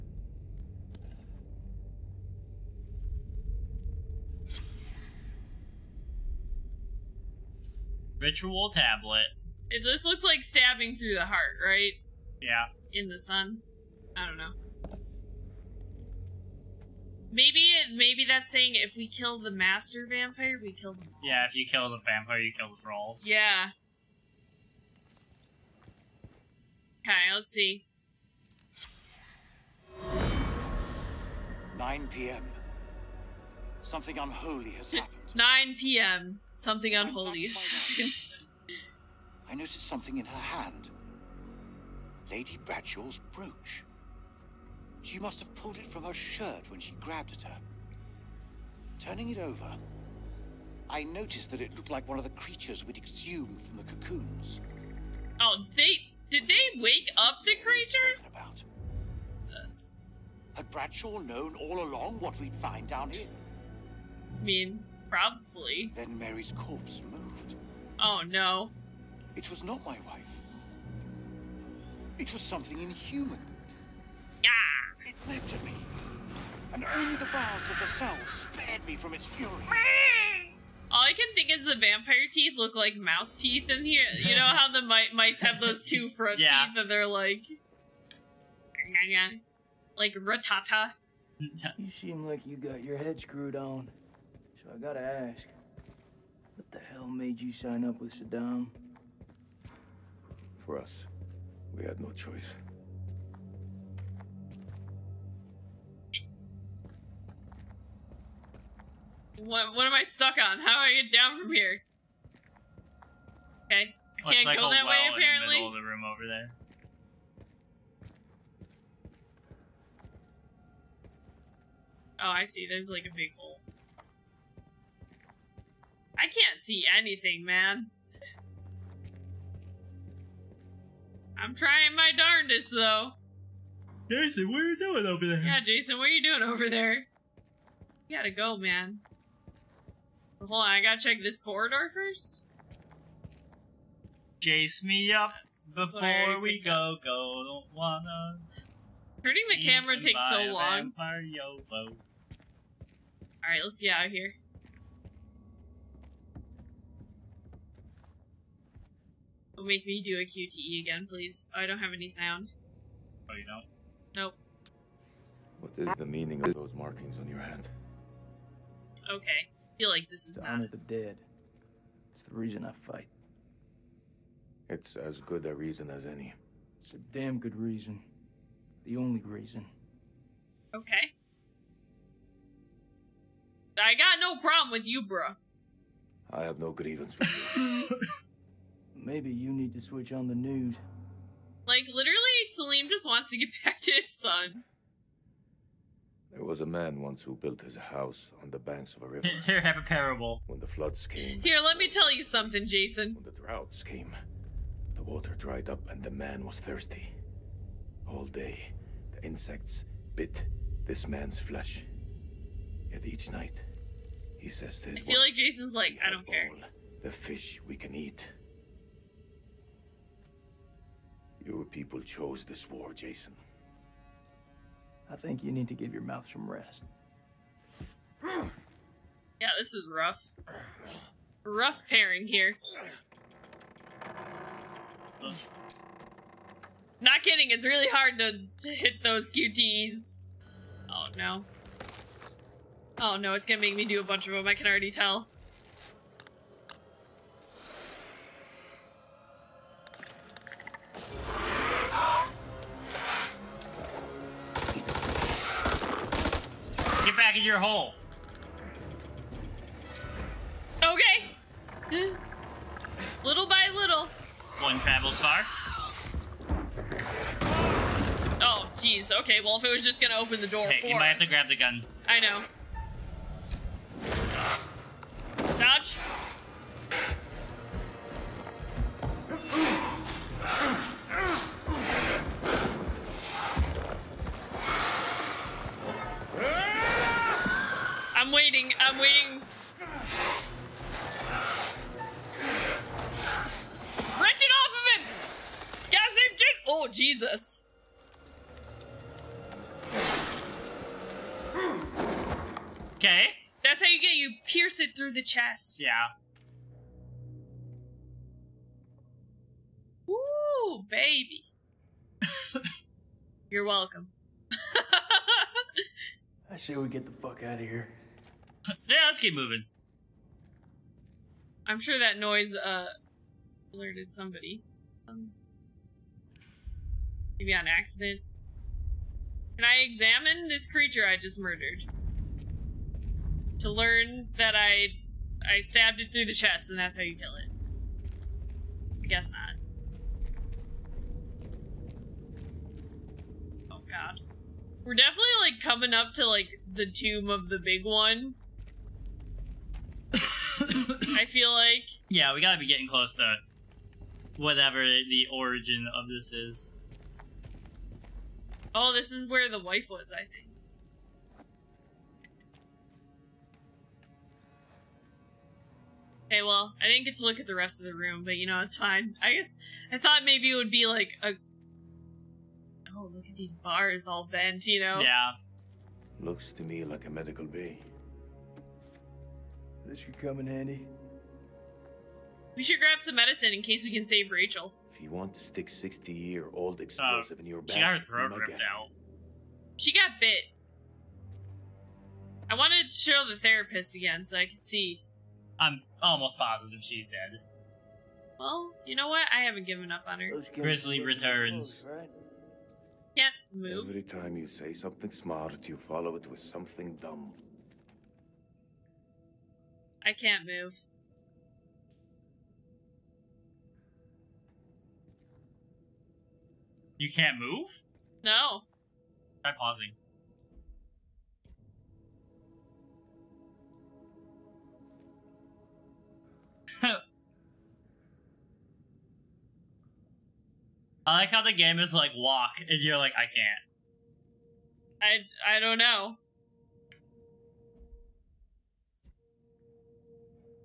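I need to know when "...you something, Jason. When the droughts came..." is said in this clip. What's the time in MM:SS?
03:22.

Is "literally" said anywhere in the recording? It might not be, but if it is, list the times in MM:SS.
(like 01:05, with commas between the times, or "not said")
03:11.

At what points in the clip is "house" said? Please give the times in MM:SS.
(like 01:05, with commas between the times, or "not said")
03:17.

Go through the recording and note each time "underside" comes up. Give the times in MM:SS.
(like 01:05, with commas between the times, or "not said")
not said.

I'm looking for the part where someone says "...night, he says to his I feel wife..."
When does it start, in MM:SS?
03:33.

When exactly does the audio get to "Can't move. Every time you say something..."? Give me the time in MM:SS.
06:43.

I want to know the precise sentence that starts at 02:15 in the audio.
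Yeah, Jason, what are you doing over there?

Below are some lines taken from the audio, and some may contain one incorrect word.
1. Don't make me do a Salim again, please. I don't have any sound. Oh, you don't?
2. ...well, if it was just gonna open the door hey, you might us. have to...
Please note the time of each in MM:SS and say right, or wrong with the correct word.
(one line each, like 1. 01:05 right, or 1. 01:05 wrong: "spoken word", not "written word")
1. 02:39 wrong: "QTE", not "Salim"
2. 04:29 right.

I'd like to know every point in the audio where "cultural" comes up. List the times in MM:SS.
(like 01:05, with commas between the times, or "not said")
not said.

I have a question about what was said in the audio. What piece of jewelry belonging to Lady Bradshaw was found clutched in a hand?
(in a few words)
brooch.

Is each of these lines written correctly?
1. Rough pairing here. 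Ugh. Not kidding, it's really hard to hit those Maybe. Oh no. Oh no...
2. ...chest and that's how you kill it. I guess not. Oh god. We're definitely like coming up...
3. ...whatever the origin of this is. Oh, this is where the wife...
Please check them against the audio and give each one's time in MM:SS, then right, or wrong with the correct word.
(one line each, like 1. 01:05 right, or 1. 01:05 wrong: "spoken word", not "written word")
1. 03:51 wrong: "QTs", not "Maybe"
2. 05:36 right
3. 05:54 right.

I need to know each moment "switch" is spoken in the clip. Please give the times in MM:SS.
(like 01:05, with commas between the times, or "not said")
03:09.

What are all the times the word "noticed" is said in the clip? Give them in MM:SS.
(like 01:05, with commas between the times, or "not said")
00:39, 00:51.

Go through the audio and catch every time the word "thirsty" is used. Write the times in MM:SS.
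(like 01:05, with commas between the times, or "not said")
03:26.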